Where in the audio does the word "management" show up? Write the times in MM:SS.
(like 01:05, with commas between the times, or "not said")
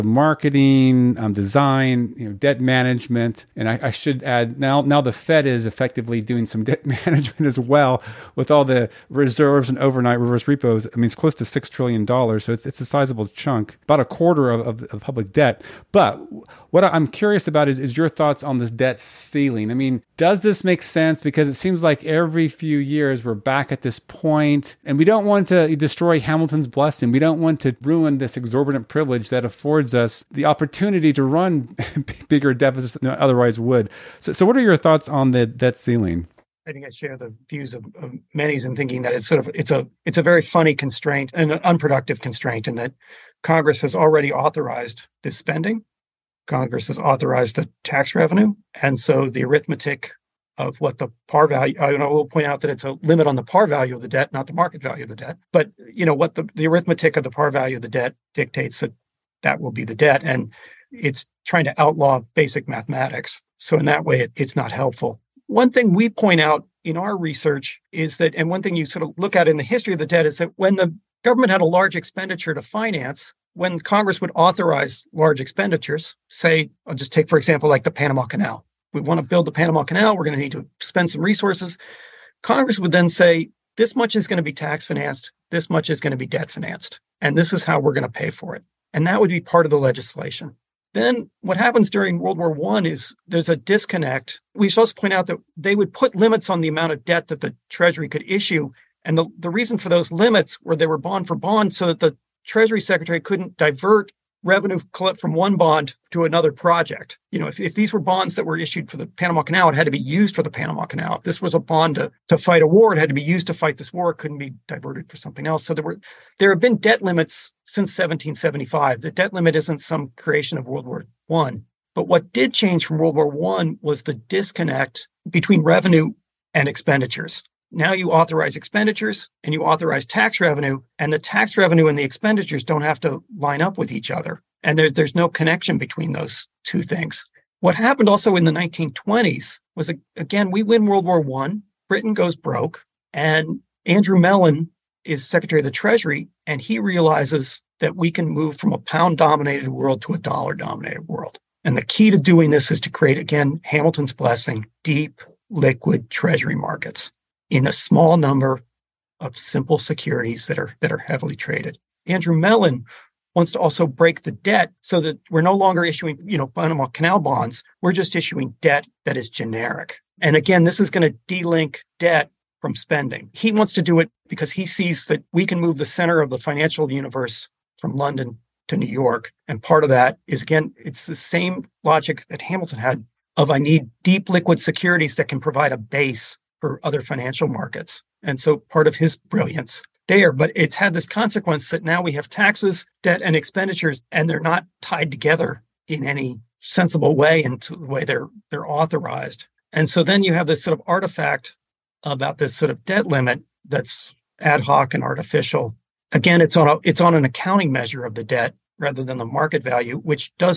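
00:02, 00:06.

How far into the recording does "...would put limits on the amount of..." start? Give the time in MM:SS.
01:35.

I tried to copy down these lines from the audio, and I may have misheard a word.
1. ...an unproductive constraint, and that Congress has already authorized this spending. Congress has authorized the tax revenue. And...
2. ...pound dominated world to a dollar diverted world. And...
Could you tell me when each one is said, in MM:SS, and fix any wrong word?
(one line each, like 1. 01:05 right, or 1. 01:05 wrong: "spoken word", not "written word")
1. 00:41 right
2. 02:28 wrong: "dominated", not "diverted".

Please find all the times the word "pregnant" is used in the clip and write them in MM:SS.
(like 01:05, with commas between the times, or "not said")
not said.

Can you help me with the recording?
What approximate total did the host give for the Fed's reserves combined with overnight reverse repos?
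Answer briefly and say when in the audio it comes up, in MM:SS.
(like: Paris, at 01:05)
6 trillion dollars, at 00:11.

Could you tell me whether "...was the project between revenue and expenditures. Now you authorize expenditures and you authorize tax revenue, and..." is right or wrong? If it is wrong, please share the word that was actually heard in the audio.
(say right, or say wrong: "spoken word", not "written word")
wrong: "disconnect", not "project".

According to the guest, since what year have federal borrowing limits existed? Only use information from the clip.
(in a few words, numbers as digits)
1775.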